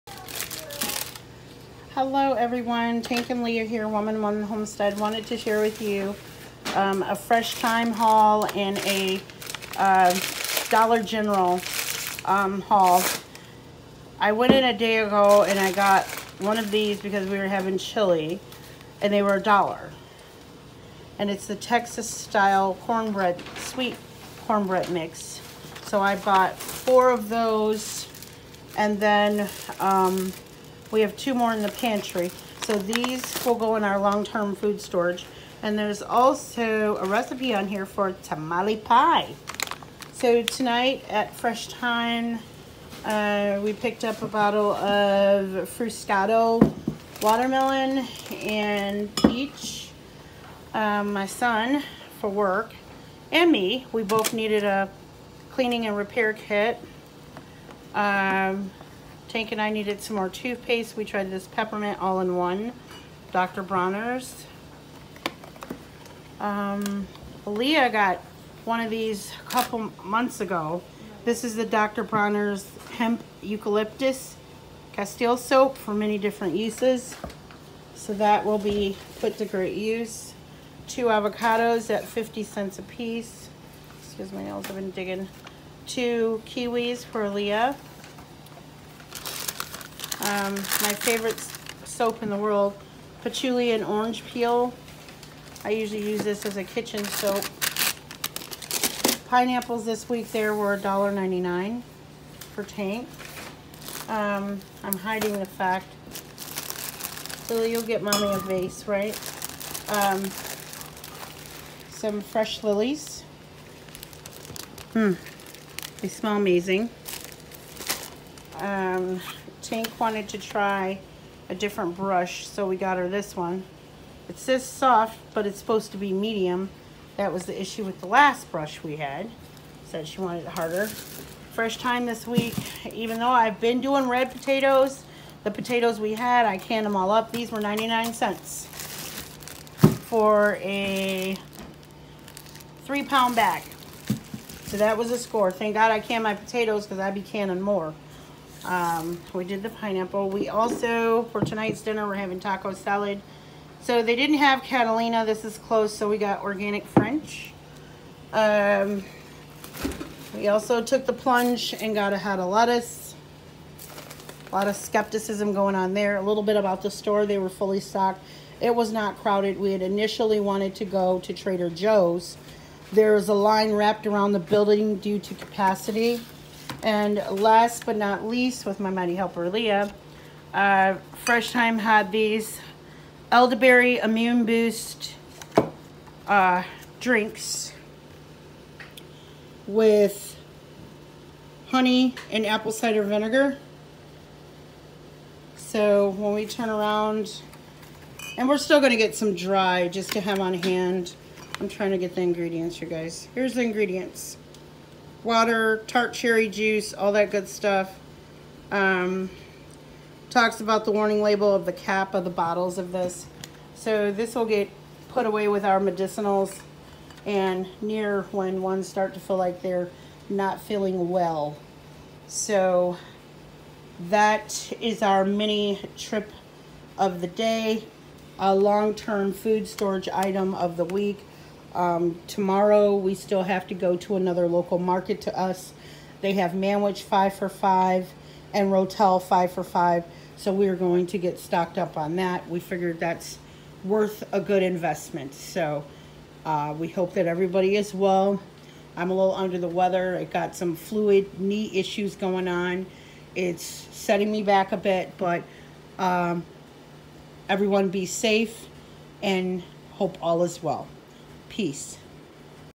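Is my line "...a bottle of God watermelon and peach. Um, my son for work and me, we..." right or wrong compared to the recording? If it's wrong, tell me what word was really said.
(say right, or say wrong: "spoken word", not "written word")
wrong: "Fruscato", not "God".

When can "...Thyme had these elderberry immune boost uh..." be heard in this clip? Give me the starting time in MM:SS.
03:01.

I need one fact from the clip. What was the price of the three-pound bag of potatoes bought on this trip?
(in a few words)
99 cents.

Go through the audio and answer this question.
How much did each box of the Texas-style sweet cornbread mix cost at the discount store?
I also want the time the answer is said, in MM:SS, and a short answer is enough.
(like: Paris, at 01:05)
$1, at 00:19.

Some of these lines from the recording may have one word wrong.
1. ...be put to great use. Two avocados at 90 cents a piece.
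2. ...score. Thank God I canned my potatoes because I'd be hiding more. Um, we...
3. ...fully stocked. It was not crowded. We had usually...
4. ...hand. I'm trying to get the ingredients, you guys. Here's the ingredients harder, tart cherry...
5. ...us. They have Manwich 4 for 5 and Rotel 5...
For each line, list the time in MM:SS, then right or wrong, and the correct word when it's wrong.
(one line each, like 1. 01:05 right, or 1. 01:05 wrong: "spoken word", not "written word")
1. 01:18 wrong: "50", not "90"
2. 02:25 wrong: "canning", not "hiding"
3. 02:47 wrong: "initially", not "usually"
4. 03:20 wrong: "water", not "harder"
5. 03:55 wrong: "5", not "4".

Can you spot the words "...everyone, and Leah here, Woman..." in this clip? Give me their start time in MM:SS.
00:02.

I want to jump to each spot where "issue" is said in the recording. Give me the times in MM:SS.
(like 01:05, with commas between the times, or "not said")
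02:07, 04:11.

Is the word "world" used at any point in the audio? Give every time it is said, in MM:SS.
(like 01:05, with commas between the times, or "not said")
01:32.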